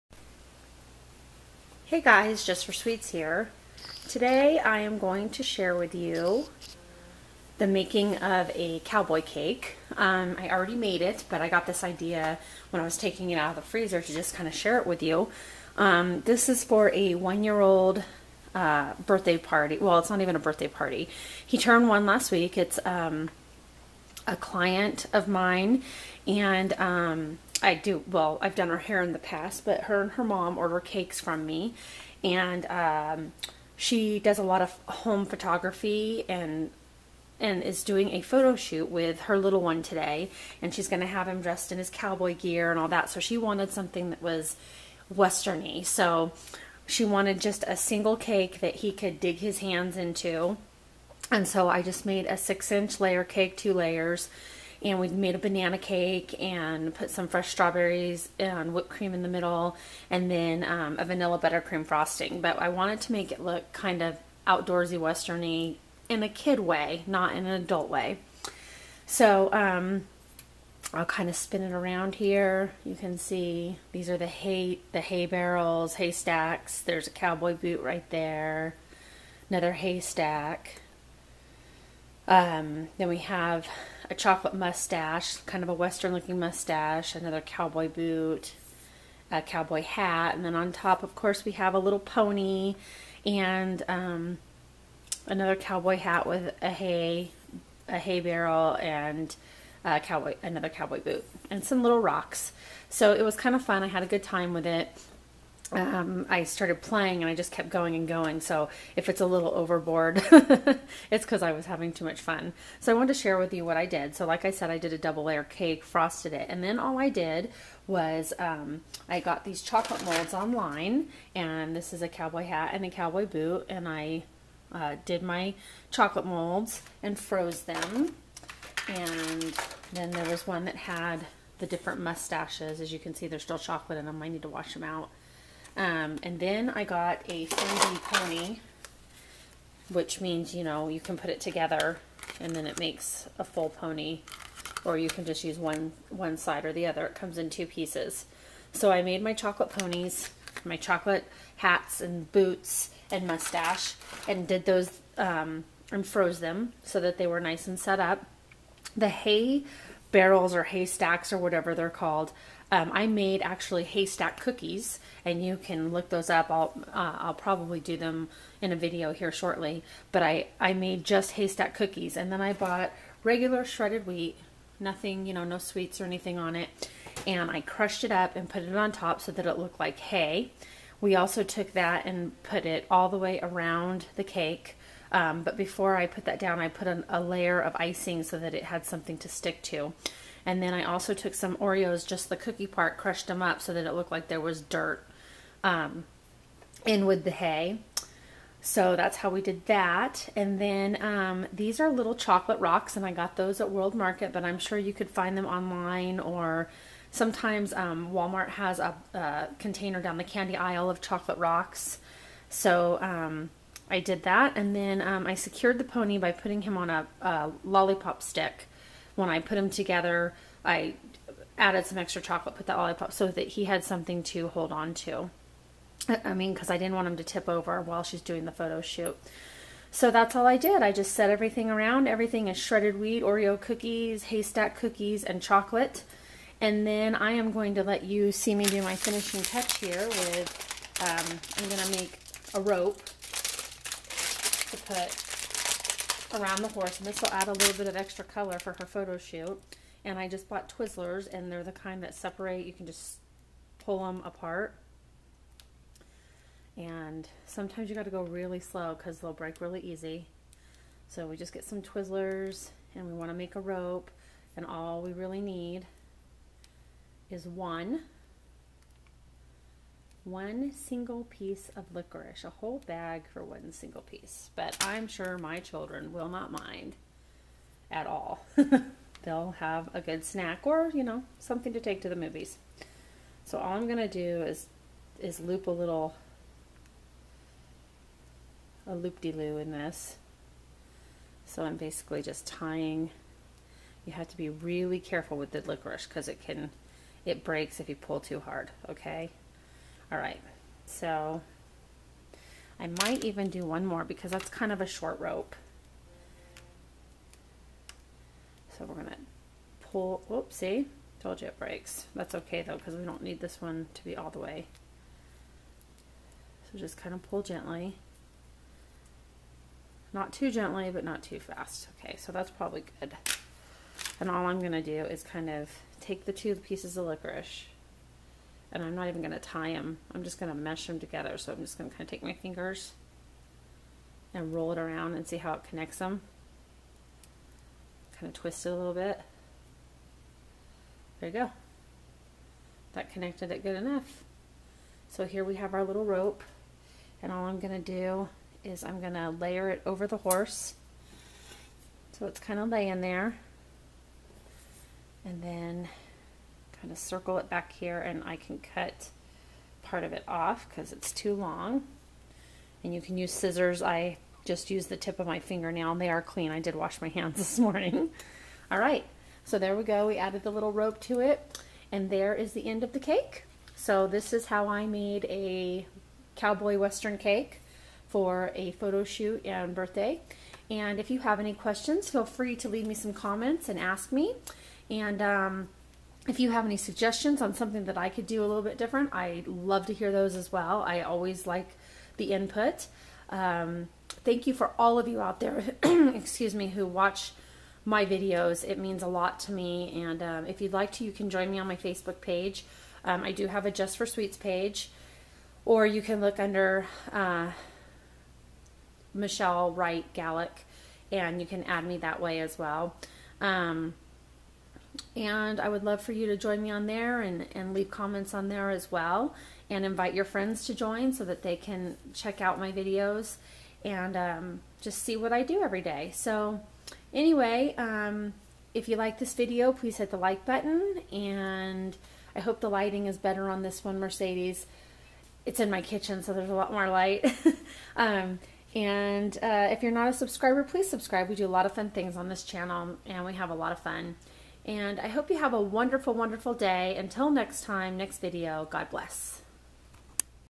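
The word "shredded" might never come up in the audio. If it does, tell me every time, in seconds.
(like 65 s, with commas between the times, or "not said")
173 s, 232 s.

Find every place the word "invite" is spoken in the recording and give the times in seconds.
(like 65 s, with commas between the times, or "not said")
419 s.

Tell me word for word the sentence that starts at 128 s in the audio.
And then there was one that had the different mustaches.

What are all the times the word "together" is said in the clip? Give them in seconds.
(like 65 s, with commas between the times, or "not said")
141 s, 219 s, 330 s.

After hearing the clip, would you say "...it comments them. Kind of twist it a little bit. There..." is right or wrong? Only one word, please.
wrong.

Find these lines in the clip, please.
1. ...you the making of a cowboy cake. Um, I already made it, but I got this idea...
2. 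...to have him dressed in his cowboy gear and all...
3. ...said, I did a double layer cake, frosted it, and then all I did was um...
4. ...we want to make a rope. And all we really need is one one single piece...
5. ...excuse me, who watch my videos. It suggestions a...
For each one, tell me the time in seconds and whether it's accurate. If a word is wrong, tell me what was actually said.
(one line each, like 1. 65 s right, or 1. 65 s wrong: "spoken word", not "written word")
1. 5 s right
2. 40 s right
3. 114 s right
4. 263 s right
5. 395 s wrong: "means", not "suggestions".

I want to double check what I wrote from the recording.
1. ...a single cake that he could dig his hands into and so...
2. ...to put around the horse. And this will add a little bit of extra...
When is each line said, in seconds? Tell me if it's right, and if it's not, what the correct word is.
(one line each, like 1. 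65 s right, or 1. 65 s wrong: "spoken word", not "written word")
1. 47 s right
2. 243 s right.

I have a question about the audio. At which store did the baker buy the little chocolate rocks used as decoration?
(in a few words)
World Market.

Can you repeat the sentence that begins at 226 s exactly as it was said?
I mean, because I didn't want him to tip over while she's doing the photo shoot.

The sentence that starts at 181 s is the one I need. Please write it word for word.
We also took that and put it all the way around the cake.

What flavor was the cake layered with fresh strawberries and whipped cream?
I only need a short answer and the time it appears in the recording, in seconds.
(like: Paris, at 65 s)
Banana, at 55 s.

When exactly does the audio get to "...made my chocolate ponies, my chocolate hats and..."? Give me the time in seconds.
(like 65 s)
149 s.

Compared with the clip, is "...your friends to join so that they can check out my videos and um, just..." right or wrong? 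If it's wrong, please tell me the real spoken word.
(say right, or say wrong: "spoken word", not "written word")
right.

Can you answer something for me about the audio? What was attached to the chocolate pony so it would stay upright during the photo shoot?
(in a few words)
A lollipop stick.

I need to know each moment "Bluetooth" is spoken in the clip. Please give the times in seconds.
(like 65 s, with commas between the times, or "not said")
not said.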